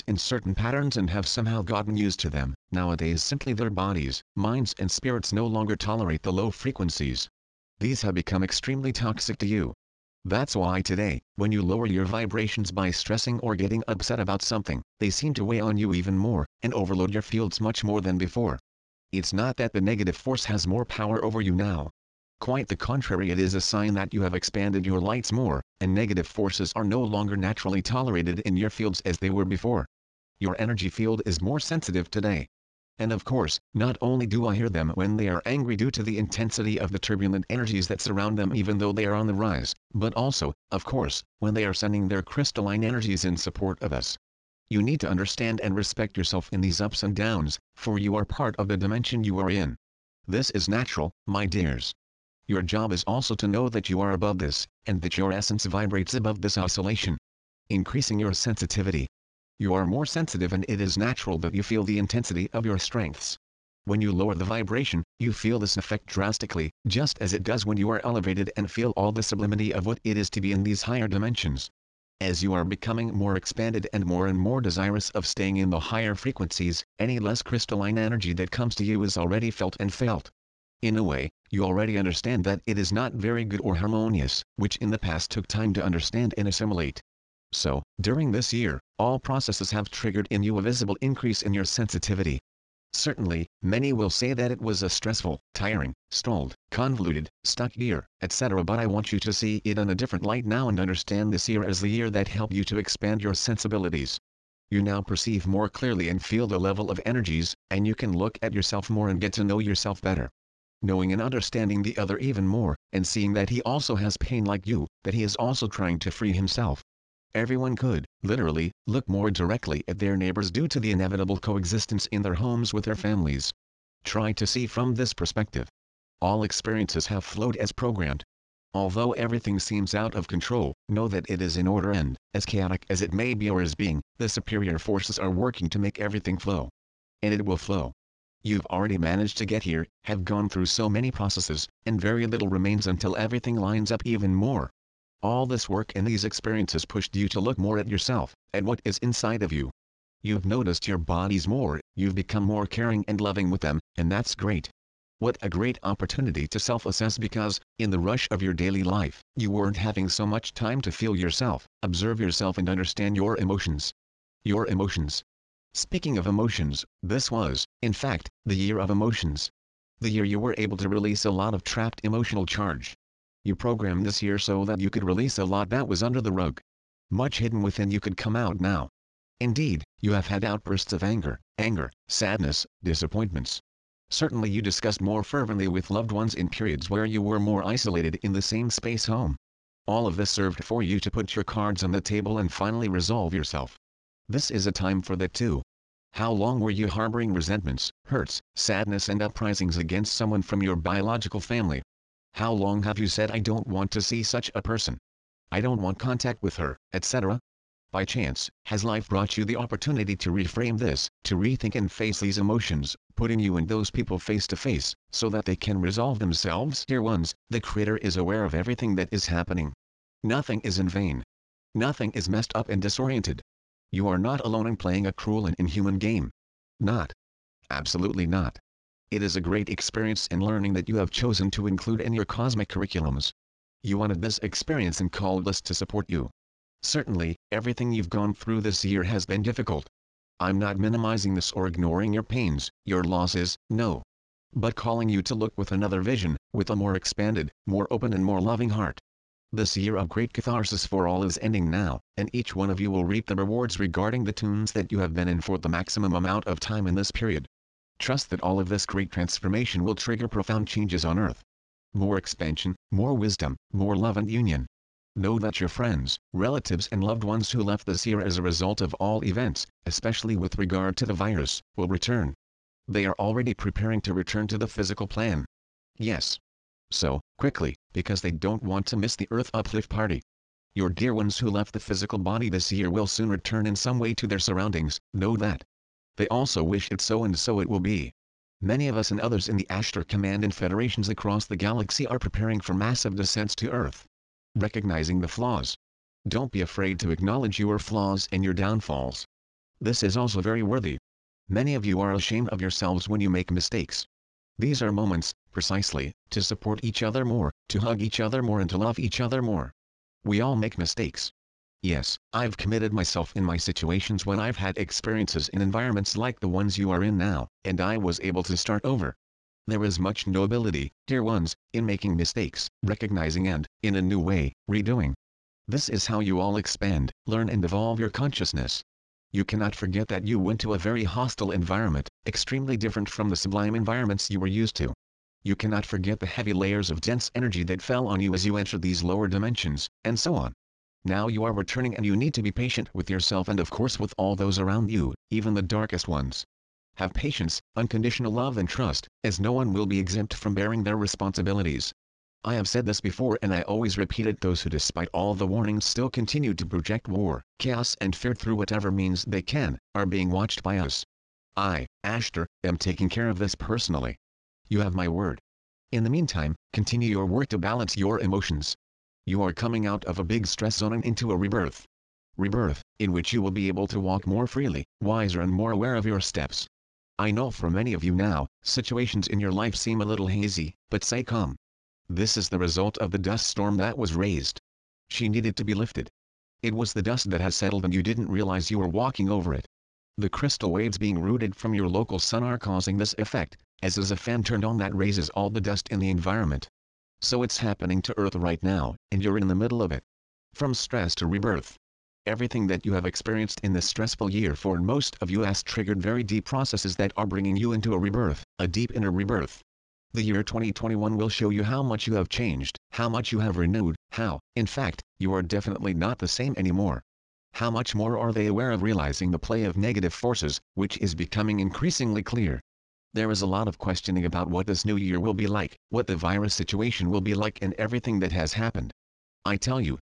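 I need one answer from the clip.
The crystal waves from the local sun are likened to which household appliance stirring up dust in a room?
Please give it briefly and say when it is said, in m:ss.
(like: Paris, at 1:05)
a fan, at 6:34.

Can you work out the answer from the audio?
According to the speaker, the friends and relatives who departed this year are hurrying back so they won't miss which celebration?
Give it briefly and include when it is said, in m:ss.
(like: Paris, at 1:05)
Earth Uplift Party, at 4:39.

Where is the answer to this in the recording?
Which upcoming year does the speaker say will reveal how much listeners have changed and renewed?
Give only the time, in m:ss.
6:50.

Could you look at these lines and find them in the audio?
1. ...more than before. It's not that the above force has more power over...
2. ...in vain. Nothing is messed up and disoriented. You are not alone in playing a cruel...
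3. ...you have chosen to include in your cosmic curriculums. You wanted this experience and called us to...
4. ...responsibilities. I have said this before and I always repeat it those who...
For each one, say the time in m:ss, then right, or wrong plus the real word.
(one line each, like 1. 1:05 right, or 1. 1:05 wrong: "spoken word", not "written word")
1. 0:17 wrong: "negative", not "above"
2. 3:40 right
3. 3:50 right
4. 5:50 right.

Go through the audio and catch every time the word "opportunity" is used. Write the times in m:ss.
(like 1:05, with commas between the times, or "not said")
2:35, 3:29.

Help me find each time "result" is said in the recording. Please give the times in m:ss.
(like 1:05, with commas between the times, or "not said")
4:28, 6:22.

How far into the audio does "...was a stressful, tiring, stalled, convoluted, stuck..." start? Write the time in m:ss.
1:34.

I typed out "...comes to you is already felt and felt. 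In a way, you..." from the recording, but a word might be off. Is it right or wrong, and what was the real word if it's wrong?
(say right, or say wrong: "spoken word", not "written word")
right.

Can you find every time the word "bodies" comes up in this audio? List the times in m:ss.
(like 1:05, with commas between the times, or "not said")
0:03, 2:30.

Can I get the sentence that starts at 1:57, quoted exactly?
Everyone could, literally, look more directly at their neighbors due to the inevitable coexistence in their homes with their families.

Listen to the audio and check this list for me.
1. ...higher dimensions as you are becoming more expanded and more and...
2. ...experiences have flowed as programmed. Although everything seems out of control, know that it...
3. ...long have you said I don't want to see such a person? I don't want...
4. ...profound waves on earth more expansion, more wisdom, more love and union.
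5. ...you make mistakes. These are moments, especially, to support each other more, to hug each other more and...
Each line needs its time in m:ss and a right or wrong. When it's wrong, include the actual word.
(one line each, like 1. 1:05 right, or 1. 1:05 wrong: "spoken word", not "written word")
1. 1:10 right
2. 2:06 right
3. 3:22 right
4. 4:20 wrong: "changes", not "waves"
5. 5:03 wrong: "precisely", not "especially".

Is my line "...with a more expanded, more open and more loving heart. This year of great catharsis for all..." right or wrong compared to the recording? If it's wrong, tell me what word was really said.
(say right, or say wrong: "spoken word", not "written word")
right.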